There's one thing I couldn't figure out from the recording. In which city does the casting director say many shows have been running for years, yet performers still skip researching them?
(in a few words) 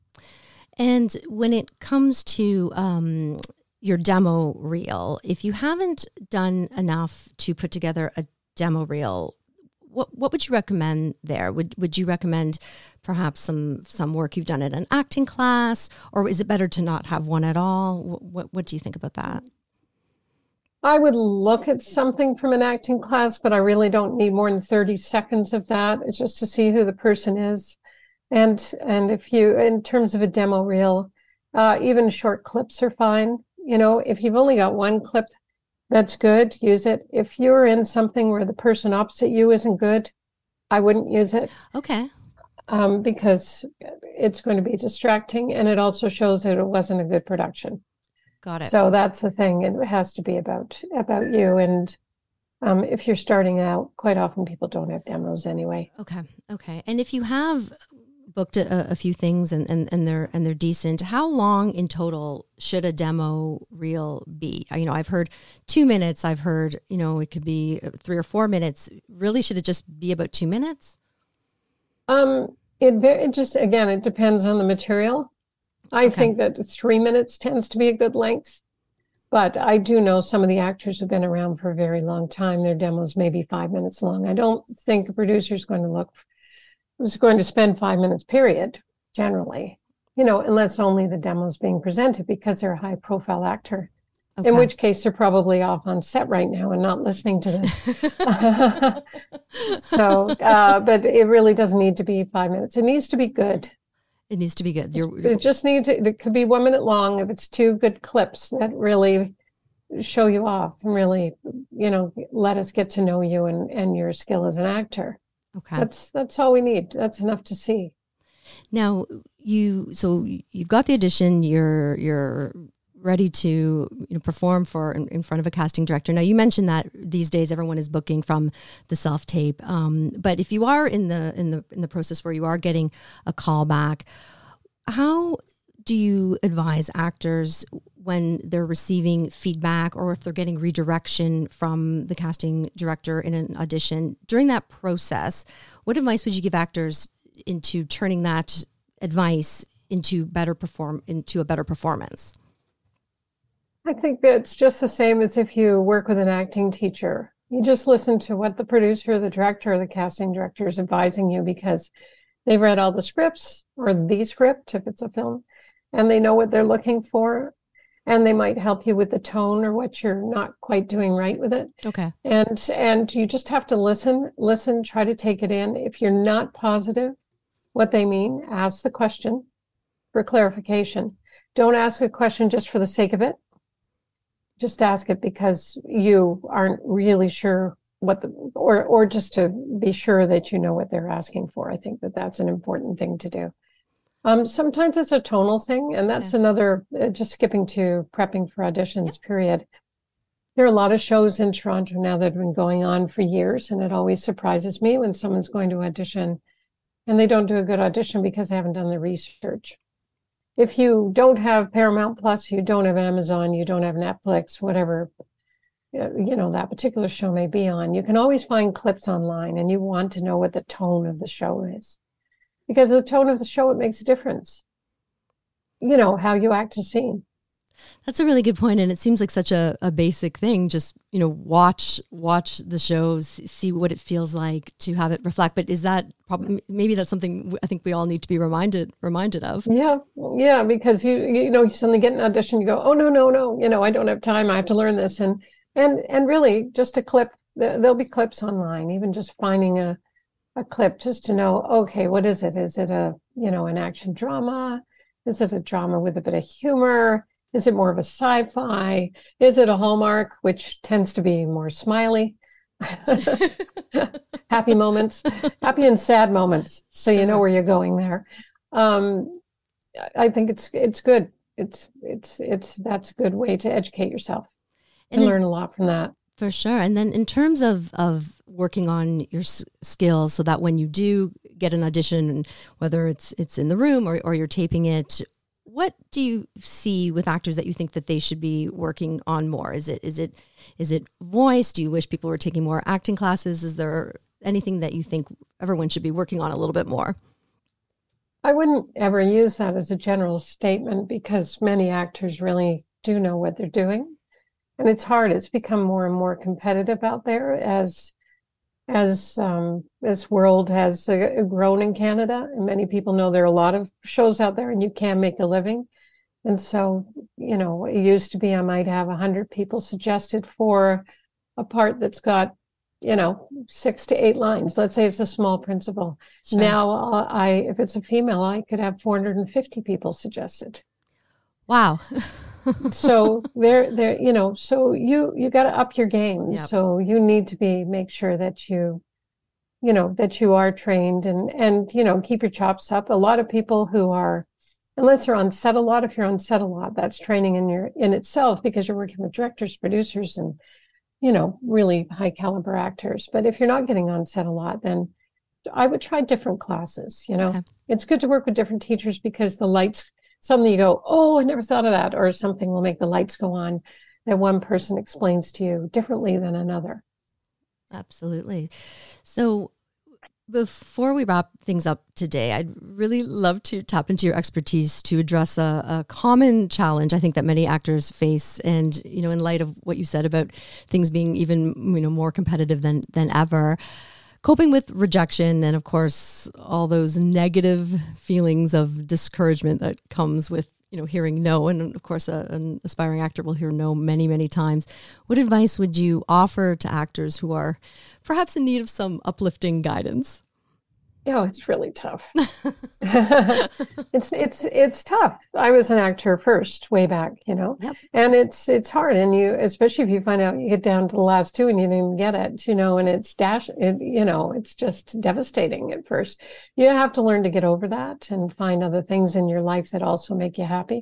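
Toronto.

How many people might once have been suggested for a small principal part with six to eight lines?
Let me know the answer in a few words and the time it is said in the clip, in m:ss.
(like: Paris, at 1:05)
100, at 5:19.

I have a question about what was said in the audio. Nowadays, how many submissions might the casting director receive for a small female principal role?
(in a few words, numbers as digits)
450.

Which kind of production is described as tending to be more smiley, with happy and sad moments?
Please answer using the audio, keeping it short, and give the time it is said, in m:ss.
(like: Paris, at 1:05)
Hallmark, at 4:19.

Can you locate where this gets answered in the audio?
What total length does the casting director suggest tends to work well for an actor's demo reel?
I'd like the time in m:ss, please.
1:16.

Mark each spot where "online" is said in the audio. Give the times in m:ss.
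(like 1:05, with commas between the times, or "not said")
3:39, 4:08.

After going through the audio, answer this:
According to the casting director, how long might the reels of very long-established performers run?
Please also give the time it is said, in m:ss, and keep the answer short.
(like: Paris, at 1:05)
5 minutes, at 1:23.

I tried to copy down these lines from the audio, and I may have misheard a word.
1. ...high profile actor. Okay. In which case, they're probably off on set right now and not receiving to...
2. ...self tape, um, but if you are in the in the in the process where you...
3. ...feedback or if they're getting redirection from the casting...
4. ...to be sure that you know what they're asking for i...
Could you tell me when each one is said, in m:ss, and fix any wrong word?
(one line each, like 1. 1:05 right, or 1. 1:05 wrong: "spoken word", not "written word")
1. 1:32 wrong: "listening", not "receiving"
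2. 2:08 right
3. 2:19 right
4. 3:09 right.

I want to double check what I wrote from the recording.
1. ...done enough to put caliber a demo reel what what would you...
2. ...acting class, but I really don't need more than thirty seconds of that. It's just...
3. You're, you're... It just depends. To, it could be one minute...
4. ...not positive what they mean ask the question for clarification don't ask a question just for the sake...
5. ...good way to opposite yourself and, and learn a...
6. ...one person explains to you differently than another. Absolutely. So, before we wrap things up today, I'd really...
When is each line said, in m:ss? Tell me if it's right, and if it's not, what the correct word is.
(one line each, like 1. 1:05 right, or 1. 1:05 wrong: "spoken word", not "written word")
1. 0:06 wrong: "together", not "caliber"
2. 0:22 right
3. 1:44 wrong: "needs", not "depends"
4. 2:56 right
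5. 4:33 wrong: "educate", not "opposite"
6. 6:04 right.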